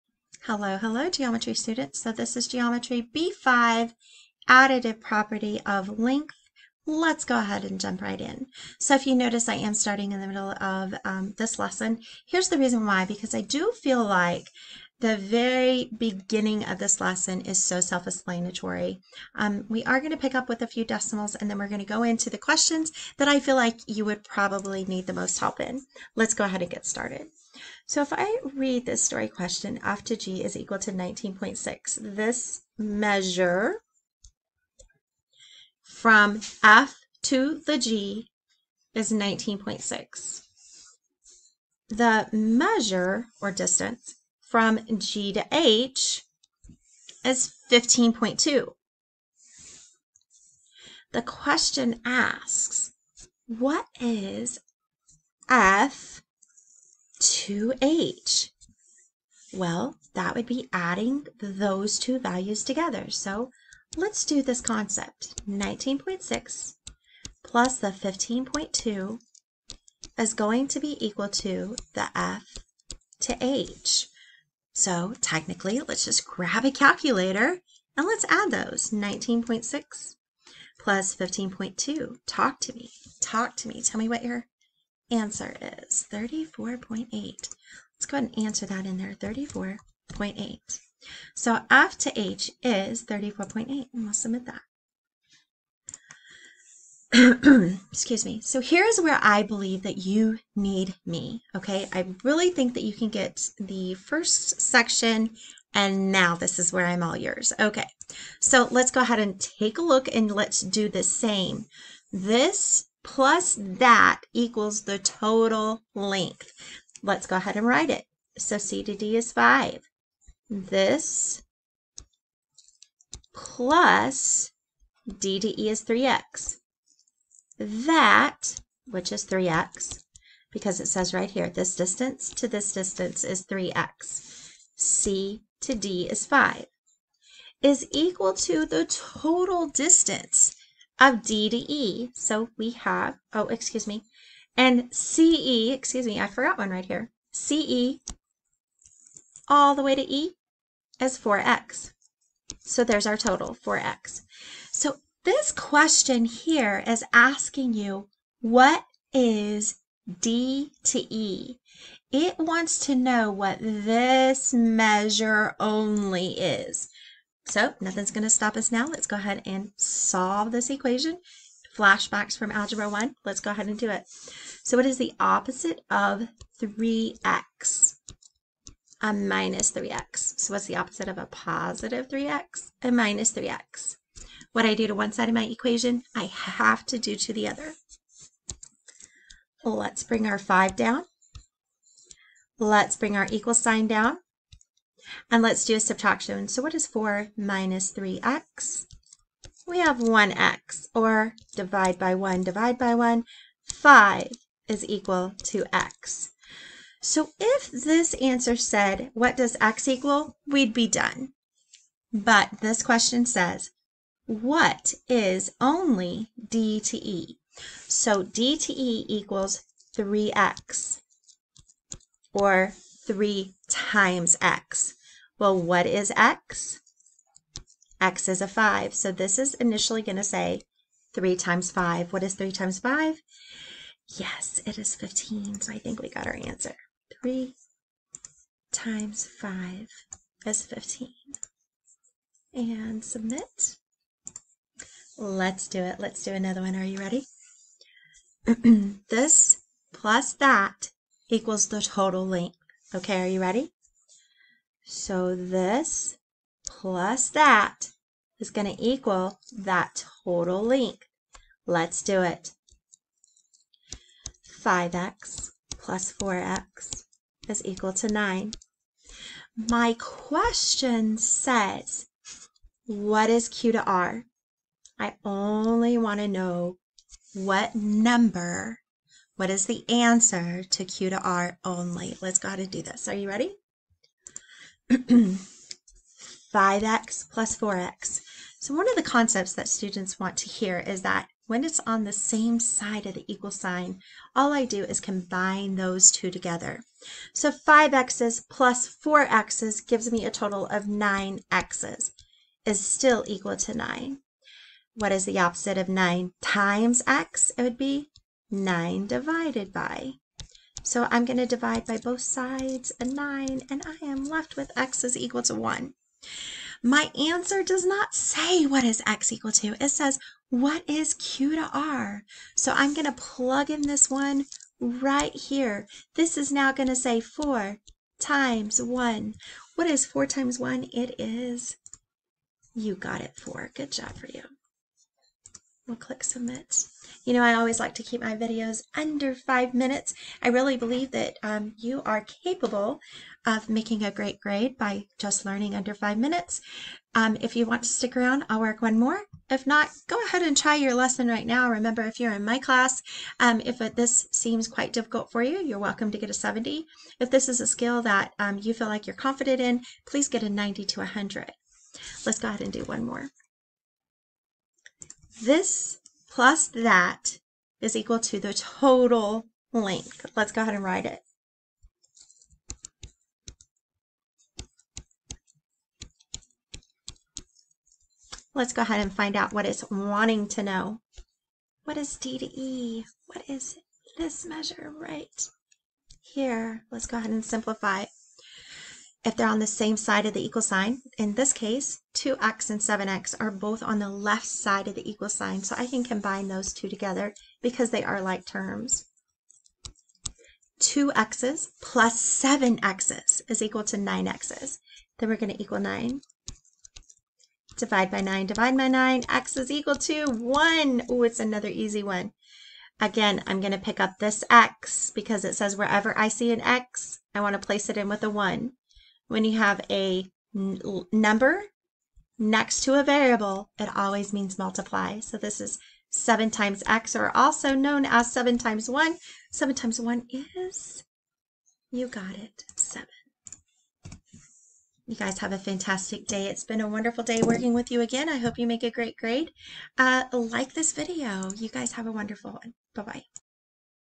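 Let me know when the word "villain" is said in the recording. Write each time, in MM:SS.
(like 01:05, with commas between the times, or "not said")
not said.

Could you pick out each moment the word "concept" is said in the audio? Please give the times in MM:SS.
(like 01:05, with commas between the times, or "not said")
01:04, 04:49.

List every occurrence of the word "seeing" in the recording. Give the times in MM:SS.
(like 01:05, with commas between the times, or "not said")
not said.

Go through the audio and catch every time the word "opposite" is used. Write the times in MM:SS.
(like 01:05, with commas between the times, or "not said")
02:55, 03:00, 05:05.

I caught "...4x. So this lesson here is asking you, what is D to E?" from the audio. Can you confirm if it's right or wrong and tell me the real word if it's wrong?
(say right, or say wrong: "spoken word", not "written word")
wrong: "question", not "lesson".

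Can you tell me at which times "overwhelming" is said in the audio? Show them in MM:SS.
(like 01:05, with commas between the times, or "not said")
not said.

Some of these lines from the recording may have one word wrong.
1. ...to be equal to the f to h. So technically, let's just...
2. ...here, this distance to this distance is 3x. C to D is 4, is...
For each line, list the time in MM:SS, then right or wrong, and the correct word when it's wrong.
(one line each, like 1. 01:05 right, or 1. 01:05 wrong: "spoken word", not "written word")
1. 01:10 right
2. 02:11 wrong: "5", not "4".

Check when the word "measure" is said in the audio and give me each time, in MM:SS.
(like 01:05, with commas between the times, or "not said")
00:32, 00:42, 02:44, 06:24.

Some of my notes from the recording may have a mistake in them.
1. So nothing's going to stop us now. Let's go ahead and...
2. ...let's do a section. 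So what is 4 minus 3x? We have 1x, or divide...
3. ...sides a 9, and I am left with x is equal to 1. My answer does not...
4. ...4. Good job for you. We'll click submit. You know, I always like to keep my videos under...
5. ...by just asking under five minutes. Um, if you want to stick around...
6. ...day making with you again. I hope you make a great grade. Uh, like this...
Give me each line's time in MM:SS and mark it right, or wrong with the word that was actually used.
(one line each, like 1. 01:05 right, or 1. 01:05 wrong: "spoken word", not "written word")
1. 02:47 right
2. 03:15 wrong: "subtraction", not "section"
3. 05:12 right
4. 05:33 right
5. 05:44 wrong: "learning", not "asking"
6. 07:17 wrong: "working", not "making".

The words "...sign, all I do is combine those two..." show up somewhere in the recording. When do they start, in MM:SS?
04:53.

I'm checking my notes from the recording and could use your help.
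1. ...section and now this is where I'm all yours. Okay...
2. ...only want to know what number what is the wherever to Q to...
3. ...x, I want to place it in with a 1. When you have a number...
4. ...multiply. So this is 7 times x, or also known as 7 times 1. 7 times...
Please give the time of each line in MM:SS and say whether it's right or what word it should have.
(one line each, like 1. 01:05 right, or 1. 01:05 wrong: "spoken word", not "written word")
1. 01:44 right
2. 04:35 wrong: "answer", not "wherever"
3. 06:56 right
4. 07:04 right.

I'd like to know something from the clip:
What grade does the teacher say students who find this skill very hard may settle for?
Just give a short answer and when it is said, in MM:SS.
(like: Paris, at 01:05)
70, at 05:56.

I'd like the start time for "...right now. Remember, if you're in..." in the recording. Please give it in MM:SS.
05:51.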